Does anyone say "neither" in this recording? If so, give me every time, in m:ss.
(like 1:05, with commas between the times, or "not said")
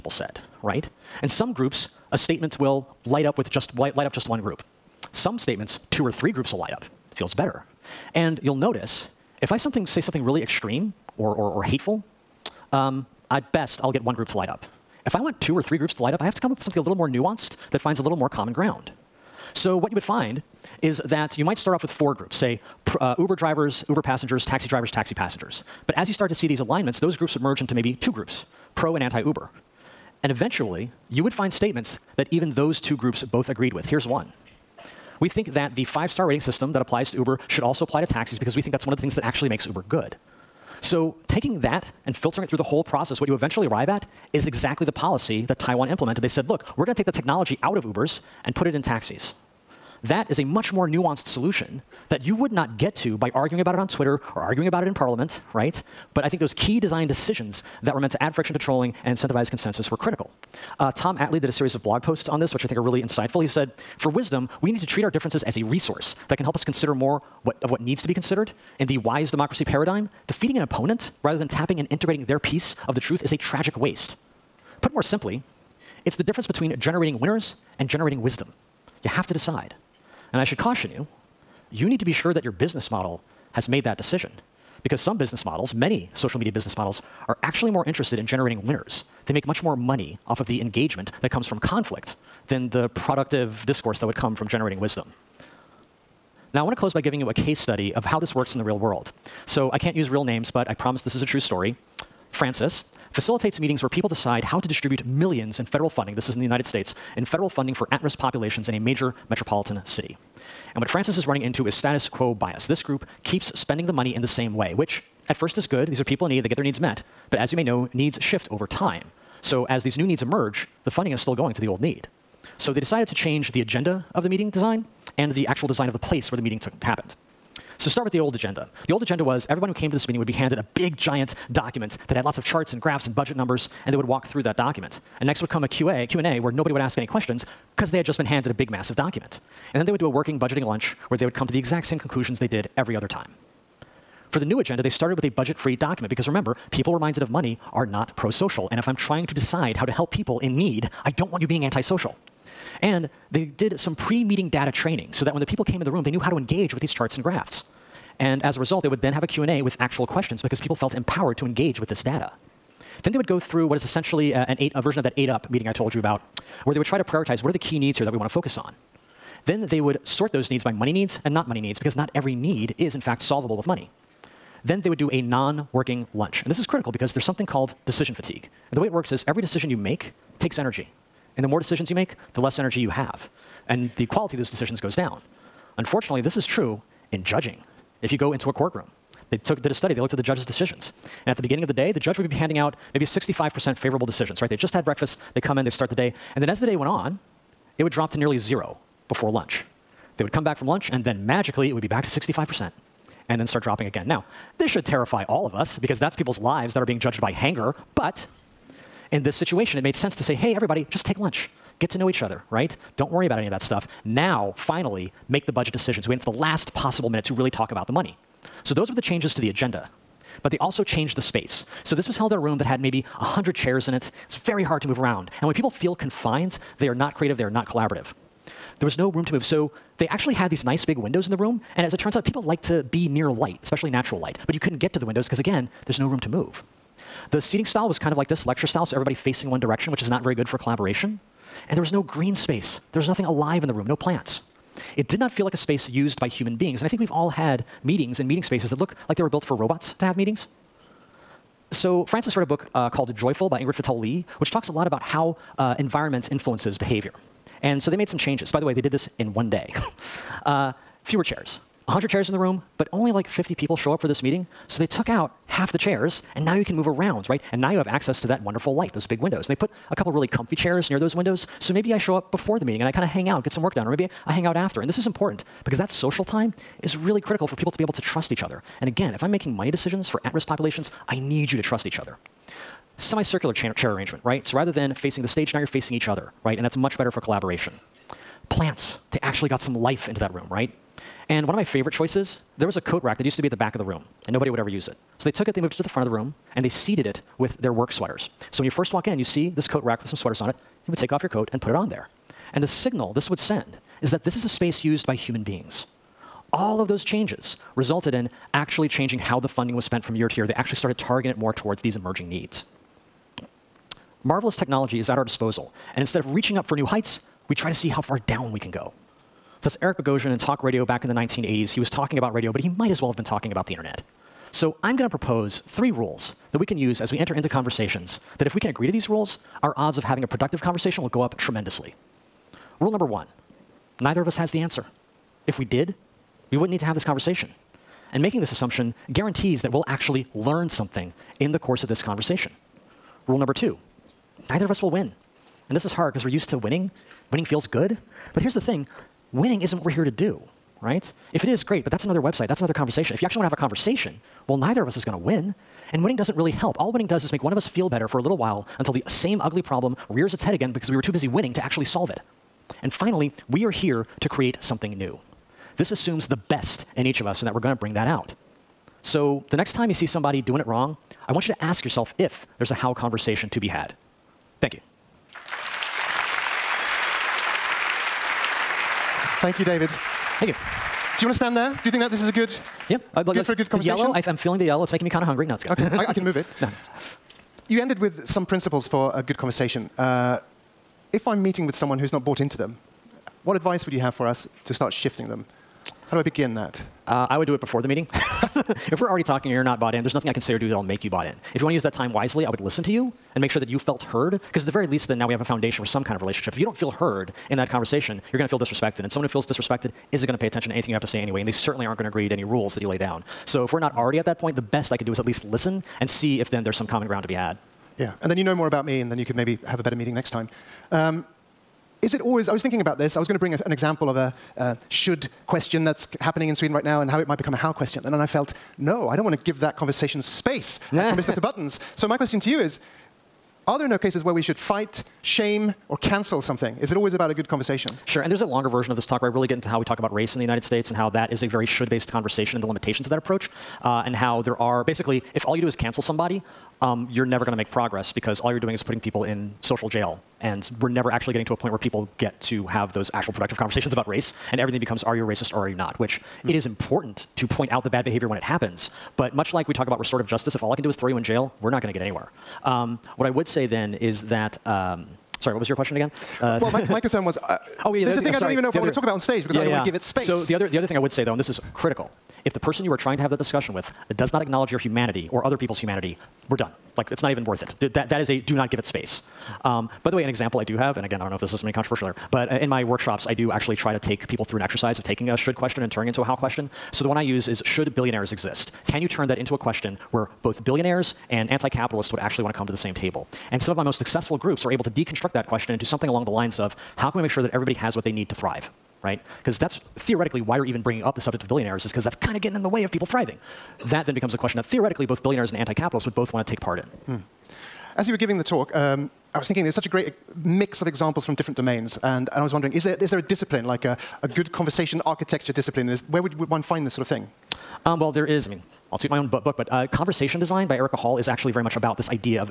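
5:33, 5:44, 5:54.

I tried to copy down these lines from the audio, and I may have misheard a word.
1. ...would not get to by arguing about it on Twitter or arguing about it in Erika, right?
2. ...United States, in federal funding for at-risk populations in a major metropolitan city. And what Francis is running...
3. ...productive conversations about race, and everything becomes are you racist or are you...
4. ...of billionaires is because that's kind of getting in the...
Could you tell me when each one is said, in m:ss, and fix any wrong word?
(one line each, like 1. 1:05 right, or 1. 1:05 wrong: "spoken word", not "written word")
1. 0:52 wrong: "Parliament", not "Erika"
2. 1:46 right
3. 7:33 right
4. 8:21 right.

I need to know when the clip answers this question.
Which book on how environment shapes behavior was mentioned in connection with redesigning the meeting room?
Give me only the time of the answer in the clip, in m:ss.
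4:13.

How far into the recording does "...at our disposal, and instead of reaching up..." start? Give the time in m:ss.
5:15.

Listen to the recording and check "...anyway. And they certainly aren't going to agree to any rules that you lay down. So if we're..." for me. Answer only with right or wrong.
right.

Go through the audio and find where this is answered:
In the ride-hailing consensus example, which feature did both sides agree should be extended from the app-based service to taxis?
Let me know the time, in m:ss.
0:35.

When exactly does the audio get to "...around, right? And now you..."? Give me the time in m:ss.
4:26.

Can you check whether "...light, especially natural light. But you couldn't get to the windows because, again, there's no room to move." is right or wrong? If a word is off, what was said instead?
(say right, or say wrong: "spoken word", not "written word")
right.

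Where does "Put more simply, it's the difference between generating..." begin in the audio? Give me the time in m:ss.
1:14.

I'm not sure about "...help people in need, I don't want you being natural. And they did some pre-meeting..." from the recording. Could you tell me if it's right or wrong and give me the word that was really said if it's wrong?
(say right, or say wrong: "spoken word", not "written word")
wrong: "antisocial", not "natural".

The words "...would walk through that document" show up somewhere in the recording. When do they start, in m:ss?
2:13.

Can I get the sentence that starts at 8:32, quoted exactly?
And, and I was wondering, is there, is there a discipline, like a, a good conversation architecture discipline?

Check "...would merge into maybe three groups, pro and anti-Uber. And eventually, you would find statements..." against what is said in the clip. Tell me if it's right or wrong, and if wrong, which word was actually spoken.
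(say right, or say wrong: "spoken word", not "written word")
wrong: "two", not "three".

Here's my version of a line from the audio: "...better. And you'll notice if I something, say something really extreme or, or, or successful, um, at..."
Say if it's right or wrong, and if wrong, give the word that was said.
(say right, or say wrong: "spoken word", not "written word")
wrong: "hateful", not "successful".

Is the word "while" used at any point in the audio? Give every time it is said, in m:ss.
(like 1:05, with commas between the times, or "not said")
5:58.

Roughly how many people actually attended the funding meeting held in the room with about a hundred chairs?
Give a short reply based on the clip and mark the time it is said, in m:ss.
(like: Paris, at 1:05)
50, at 4:23.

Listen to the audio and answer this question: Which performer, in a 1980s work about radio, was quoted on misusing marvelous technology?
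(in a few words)
Eric Bogosian.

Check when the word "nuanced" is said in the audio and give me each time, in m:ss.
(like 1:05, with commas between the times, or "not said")
0:17, 0:50.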